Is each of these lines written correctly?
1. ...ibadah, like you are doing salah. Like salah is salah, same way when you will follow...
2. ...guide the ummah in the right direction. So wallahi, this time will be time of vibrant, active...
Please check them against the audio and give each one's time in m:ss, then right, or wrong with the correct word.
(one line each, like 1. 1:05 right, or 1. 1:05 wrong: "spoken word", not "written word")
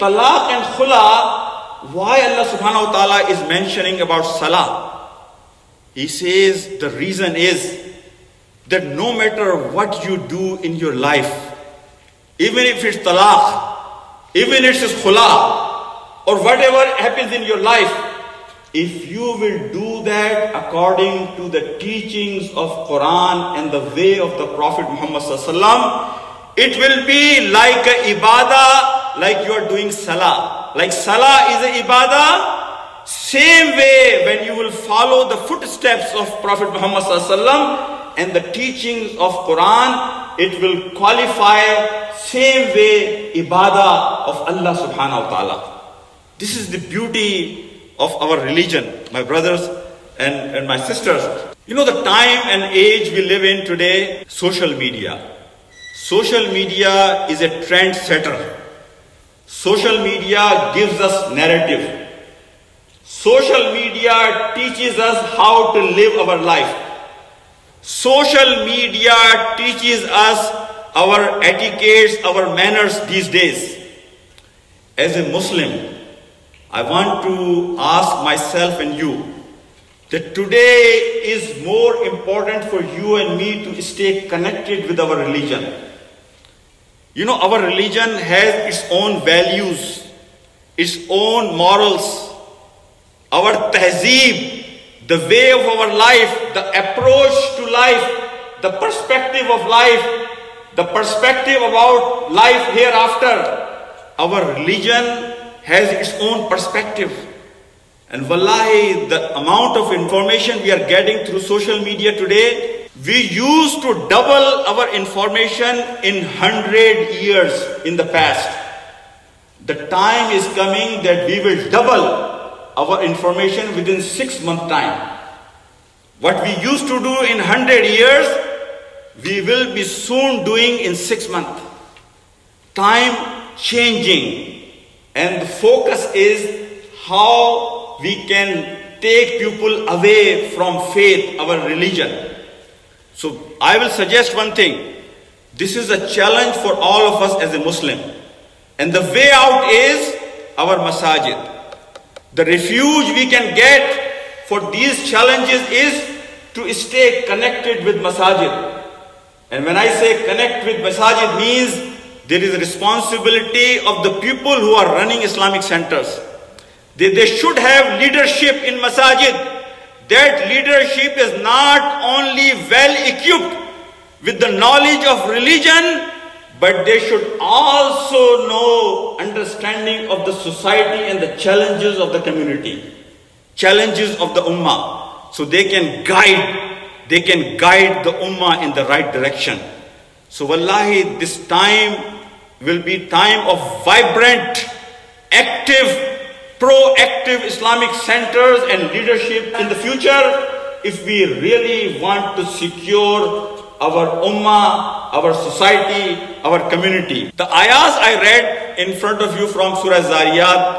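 1. 0:28 wrong: "ibadah", not "salah"
2. 3:07 right.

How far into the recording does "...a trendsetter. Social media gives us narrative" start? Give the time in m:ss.
0:57.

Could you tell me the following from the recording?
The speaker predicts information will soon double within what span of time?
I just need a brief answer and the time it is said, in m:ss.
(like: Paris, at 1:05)
six months, at 2:04.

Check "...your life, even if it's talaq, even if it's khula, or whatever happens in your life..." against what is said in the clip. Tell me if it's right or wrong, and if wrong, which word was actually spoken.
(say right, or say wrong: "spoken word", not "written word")
right.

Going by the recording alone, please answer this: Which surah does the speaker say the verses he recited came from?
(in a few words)
Surah Zariyat.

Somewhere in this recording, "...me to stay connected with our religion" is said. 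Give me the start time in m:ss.
1:23.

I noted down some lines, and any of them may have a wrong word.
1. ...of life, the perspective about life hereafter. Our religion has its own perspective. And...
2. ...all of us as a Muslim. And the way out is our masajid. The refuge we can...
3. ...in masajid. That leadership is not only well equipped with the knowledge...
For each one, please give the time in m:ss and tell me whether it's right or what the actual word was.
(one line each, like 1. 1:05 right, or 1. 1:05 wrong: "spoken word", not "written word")
1. 1:39 right
2. 2:26 right
3. 2:48 right.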